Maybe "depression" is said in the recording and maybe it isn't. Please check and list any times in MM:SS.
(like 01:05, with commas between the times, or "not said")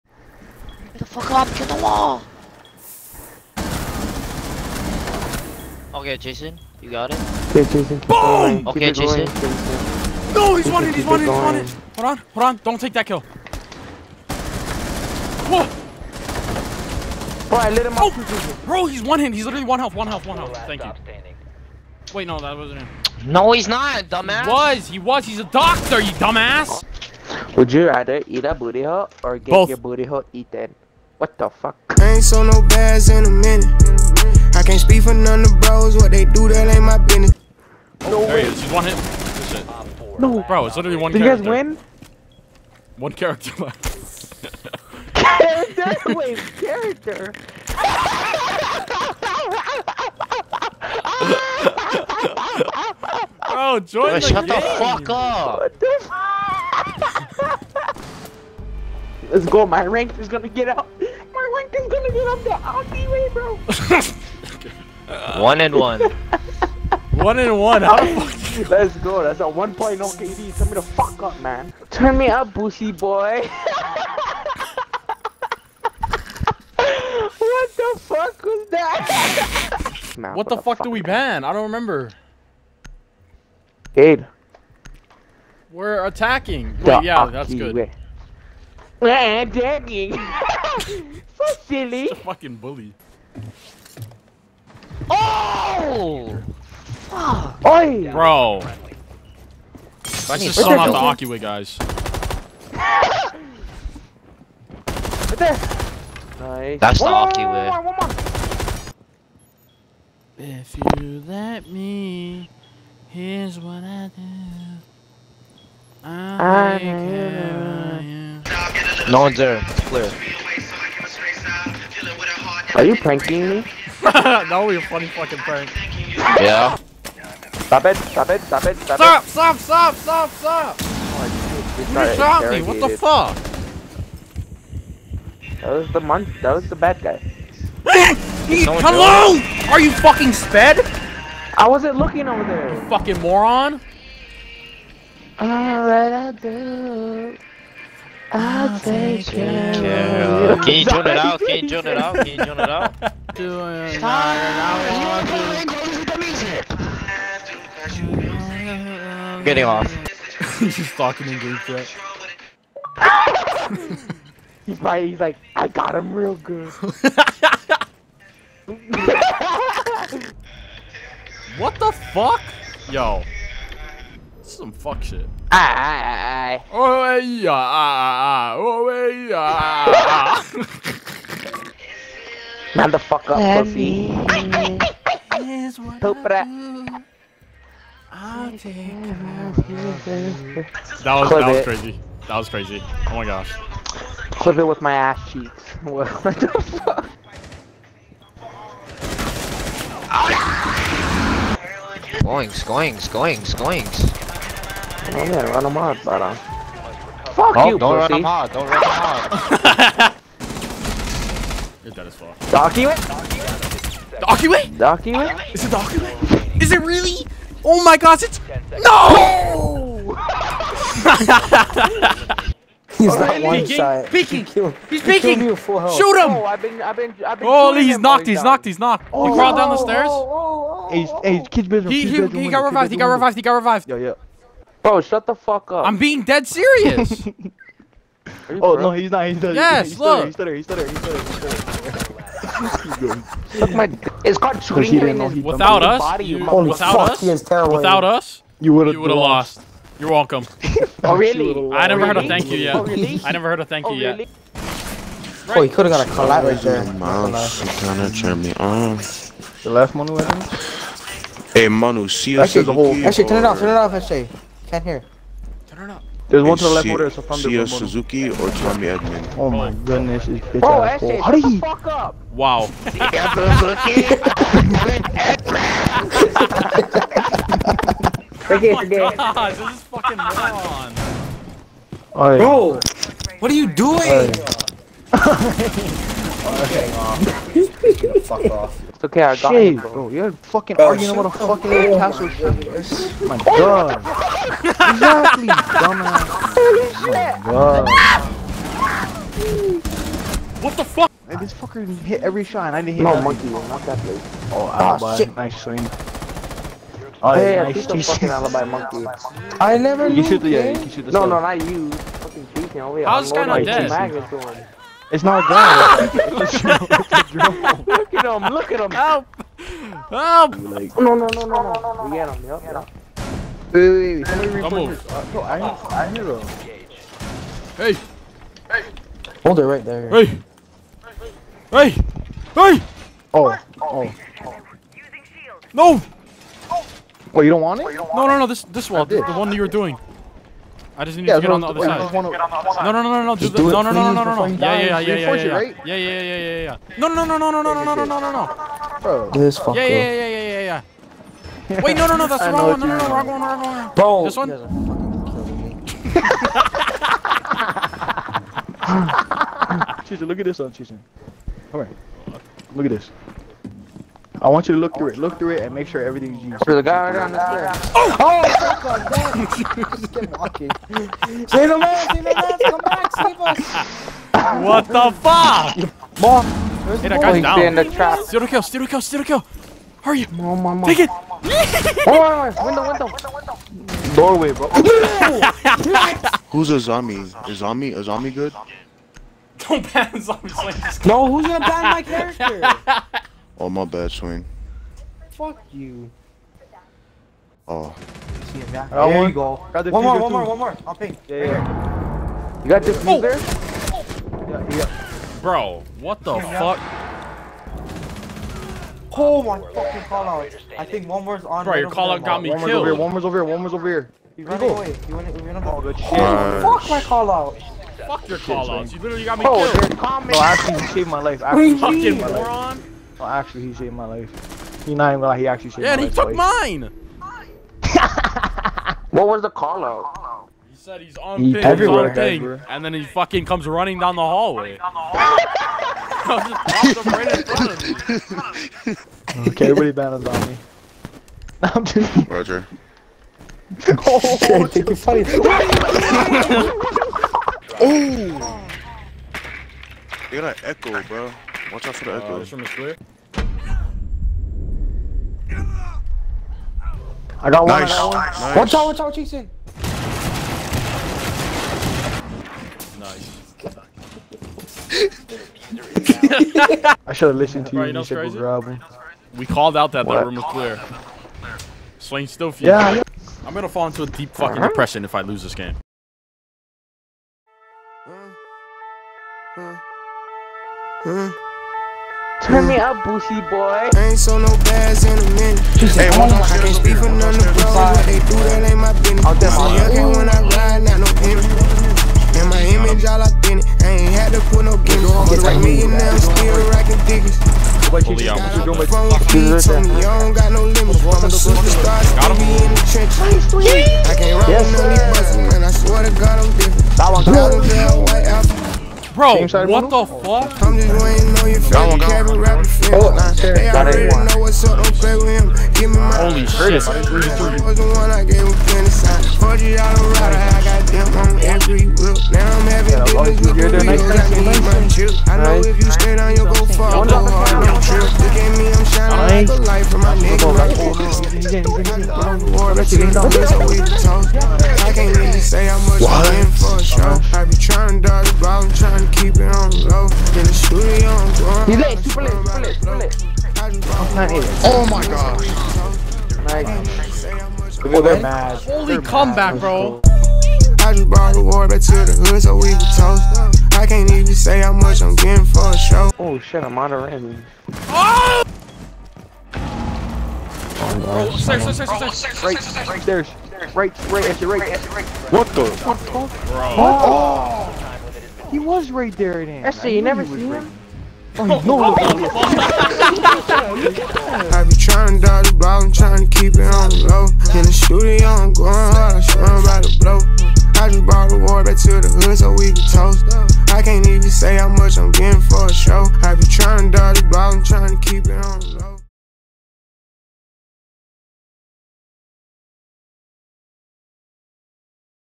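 07:54.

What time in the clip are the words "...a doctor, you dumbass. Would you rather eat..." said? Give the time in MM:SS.
00:25.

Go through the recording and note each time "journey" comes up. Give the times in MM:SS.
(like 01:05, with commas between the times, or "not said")
not said.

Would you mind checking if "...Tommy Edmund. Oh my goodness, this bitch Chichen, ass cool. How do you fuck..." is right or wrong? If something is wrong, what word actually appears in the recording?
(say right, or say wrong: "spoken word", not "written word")
wrong: "Bro", not "Chichen".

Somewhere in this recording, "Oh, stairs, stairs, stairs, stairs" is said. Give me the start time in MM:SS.
09:21.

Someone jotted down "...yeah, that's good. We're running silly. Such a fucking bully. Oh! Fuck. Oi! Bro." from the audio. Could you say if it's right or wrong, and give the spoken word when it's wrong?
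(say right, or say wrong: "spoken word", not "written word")
wrong: "attacking", not "running".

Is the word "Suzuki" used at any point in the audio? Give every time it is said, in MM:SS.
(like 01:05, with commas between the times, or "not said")
04:27.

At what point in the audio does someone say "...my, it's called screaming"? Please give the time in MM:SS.
04:03.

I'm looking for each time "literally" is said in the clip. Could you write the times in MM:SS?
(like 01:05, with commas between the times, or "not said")
00:19, 00:40, 06:58.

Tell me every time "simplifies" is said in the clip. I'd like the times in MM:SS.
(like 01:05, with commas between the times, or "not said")
not said.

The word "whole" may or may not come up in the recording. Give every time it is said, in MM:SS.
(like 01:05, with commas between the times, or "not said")
04:22.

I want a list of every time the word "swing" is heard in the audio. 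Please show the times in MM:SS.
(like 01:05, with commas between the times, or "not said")
05:05, 06:34.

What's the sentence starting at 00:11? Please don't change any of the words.
Hold on, hold on, don't take that kill.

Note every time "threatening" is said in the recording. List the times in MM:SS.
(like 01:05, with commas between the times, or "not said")
not said.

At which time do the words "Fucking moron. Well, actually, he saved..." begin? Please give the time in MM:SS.
07:02.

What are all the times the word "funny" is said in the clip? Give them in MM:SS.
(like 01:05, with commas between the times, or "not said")
02:04, 07:24.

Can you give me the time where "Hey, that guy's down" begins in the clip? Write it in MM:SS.
06:17.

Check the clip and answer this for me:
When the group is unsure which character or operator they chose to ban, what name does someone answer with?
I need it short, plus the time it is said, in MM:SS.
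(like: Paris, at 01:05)
Gabe, at 01:23.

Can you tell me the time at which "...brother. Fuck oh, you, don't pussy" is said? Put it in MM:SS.
03:26.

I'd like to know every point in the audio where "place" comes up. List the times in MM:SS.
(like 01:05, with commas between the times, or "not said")
05:03.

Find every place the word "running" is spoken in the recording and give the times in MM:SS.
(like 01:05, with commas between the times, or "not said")
07:13.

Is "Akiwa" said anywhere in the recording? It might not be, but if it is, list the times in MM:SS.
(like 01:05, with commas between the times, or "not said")
01:41, 01:47.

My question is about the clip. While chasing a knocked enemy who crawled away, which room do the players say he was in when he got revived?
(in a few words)
kid's bedroom.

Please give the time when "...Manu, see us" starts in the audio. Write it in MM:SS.
04:21.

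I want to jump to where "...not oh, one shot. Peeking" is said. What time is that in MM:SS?
03:43.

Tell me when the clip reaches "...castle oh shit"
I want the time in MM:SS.
04:51.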